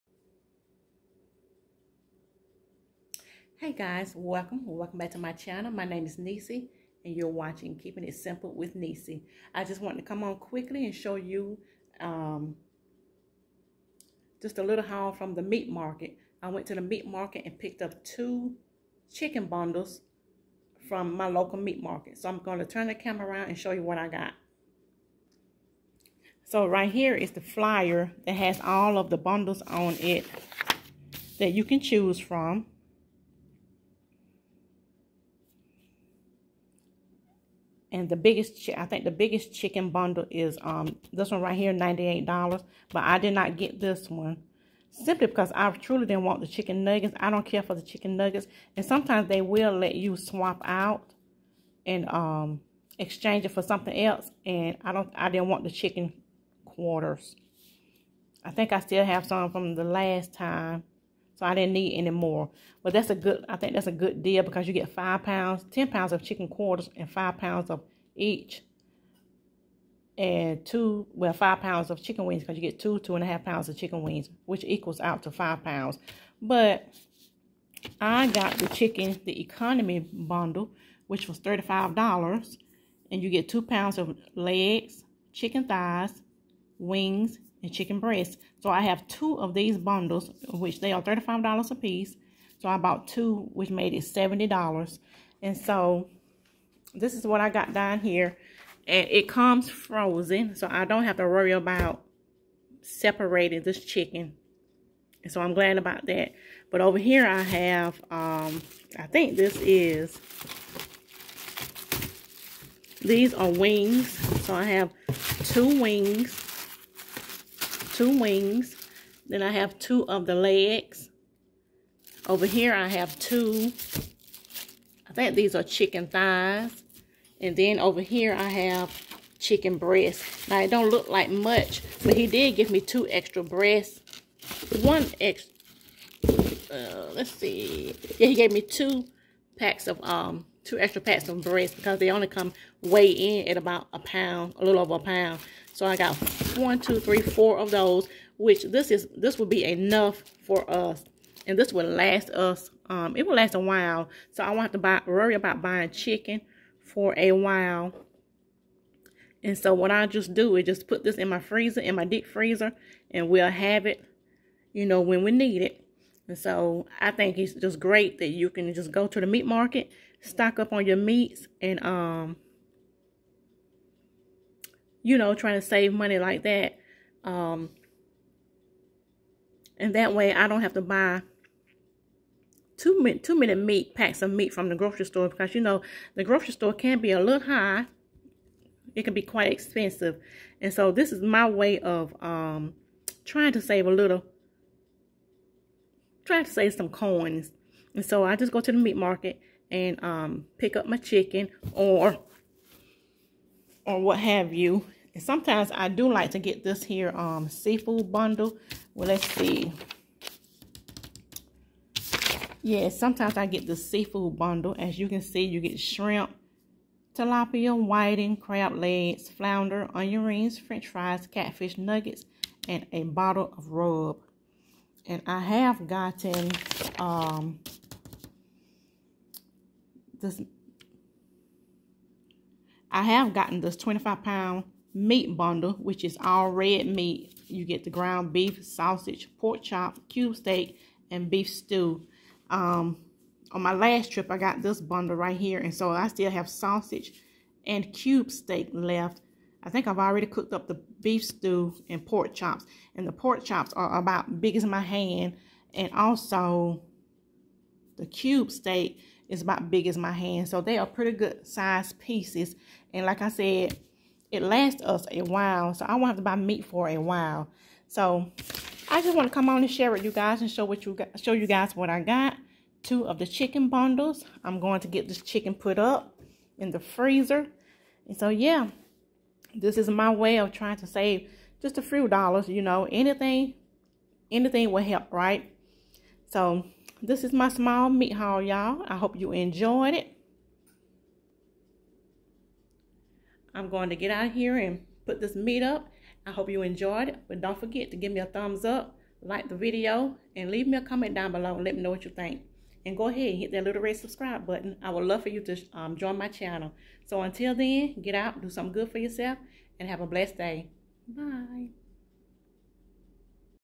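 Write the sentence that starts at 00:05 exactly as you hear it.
My name is Nissy and you're watching Keeping It Simple with Nissy.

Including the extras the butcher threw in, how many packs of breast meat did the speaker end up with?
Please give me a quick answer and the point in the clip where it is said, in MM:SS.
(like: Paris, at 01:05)
4, at 02:27.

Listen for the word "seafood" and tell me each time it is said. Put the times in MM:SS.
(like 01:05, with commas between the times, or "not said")
03:27, 03:33.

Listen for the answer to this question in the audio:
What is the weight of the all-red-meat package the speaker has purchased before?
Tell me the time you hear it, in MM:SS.
03:53.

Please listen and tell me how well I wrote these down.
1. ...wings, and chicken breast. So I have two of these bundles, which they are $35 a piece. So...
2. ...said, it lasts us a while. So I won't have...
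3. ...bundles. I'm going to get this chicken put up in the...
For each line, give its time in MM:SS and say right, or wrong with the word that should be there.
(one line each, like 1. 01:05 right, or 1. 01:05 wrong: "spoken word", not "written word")
1. 01:26 right
2. 04:23 right
3. 04:33 right.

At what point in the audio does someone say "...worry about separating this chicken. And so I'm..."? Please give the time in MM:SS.
01:41.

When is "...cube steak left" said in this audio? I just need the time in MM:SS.
04:07.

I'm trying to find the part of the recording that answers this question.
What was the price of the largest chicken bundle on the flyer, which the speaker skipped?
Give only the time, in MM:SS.
00:41.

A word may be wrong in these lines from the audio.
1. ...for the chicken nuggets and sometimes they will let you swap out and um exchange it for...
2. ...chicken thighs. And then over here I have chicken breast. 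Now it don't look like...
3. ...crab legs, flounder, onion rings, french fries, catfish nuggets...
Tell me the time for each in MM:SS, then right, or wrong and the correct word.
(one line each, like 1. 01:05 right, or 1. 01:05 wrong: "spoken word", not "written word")
1. 00:47 right
2. 02:05 right
3. 03:38 right.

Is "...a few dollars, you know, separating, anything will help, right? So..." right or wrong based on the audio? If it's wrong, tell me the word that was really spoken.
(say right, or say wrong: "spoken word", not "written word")
wrong: "anything", not "separating".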